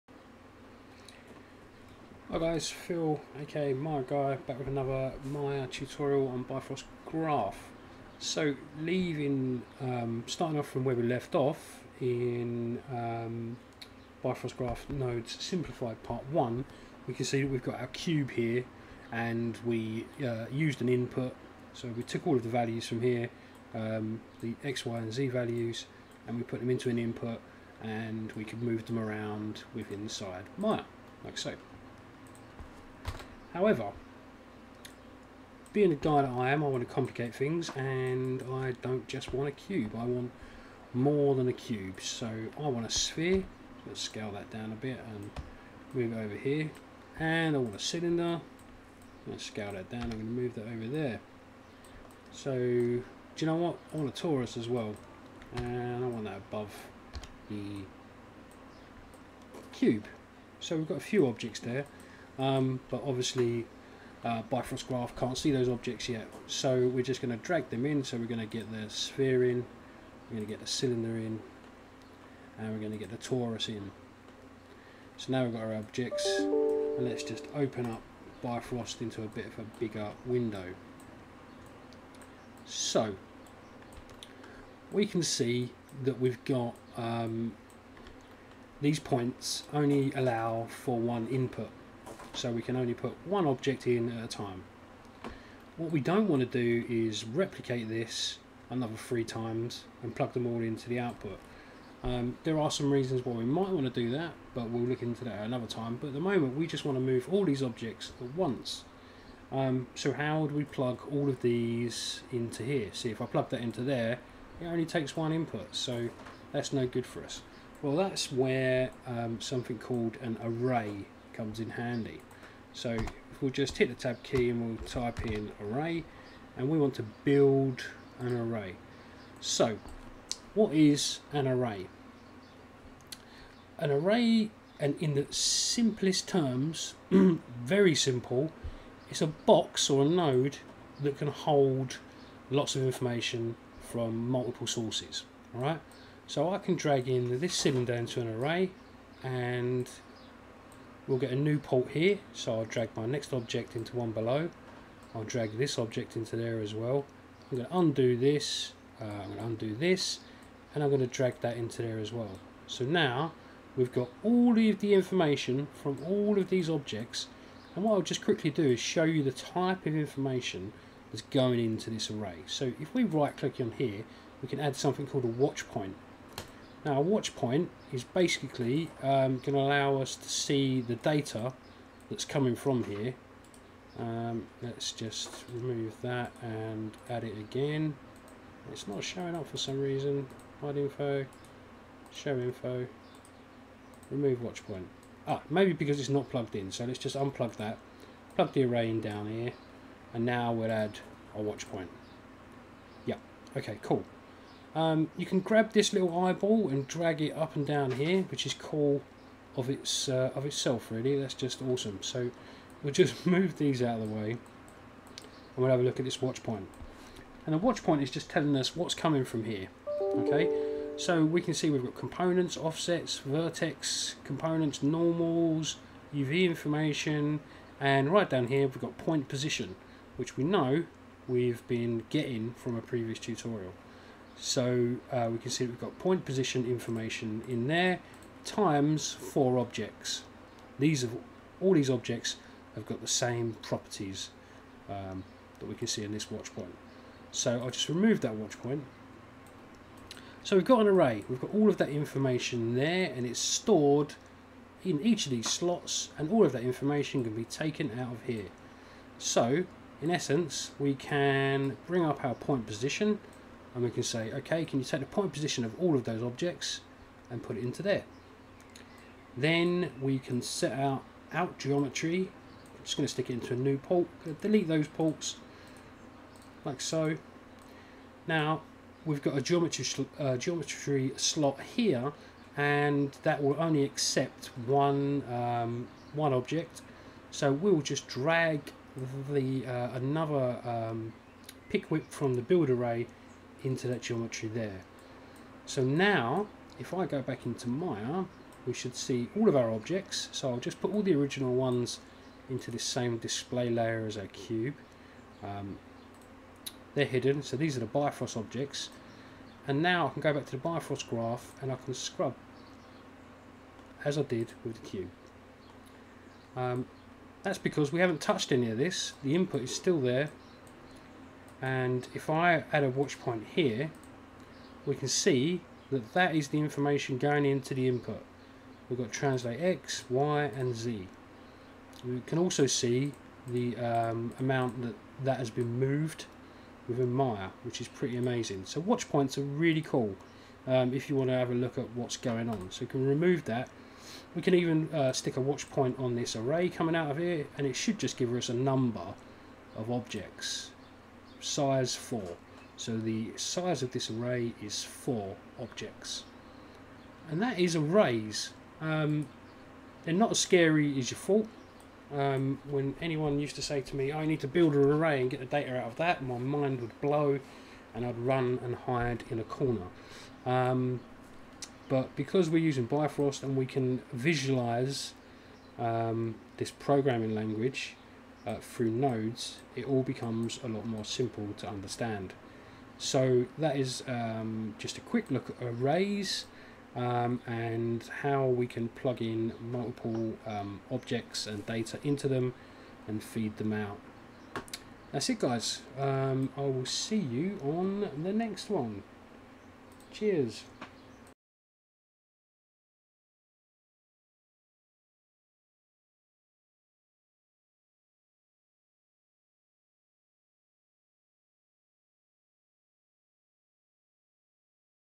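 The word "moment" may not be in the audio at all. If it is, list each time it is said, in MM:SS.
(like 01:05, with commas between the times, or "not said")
01:46.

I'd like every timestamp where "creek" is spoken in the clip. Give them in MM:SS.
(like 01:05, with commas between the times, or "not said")
not said.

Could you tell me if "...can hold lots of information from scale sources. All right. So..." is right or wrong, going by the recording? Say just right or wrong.
wrong.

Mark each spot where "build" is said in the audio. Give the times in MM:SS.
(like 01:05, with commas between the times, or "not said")
02:07, 04:52, 06:04.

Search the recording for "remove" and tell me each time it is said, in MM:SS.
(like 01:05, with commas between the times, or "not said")
03:05, 03:14, 04:07, 05:43.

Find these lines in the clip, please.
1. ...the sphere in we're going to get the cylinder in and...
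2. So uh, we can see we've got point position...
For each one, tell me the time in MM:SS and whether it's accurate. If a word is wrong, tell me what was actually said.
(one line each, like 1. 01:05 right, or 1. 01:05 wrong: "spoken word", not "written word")
1. 01:08 right
2. 03:54 right.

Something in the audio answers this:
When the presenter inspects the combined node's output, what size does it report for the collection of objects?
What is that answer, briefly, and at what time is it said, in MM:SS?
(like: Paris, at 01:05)
4, at 05:51.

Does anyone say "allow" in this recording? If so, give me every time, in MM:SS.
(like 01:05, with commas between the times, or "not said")
01:30, 02:59.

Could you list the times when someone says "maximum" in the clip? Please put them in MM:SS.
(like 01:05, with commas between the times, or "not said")
not said.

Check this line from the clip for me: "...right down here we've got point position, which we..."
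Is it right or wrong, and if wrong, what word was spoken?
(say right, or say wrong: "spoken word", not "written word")
right.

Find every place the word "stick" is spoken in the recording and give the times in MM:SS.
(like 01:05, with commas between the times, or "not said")
04:33, 05:45.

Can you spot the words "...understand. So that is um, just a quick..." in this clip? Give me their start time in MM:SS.
06:21.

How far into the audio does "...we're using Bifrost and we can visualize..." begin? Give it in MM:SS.
06:12.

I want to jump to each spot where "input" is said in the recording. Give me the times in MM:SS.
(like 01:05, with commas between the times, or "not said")
00:20, 00:26, 01:31, 01:55, 05:19, 05:27.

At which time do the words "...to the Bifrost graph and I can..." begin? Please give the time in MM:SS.
05:10.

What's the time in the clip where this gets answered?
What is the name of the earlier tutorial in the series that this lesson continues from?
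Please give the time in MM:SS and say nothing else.
00:14.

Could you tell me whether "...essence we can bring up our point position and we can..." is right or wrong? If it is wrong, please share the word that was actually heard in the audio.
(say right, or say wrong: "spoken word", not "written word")
right.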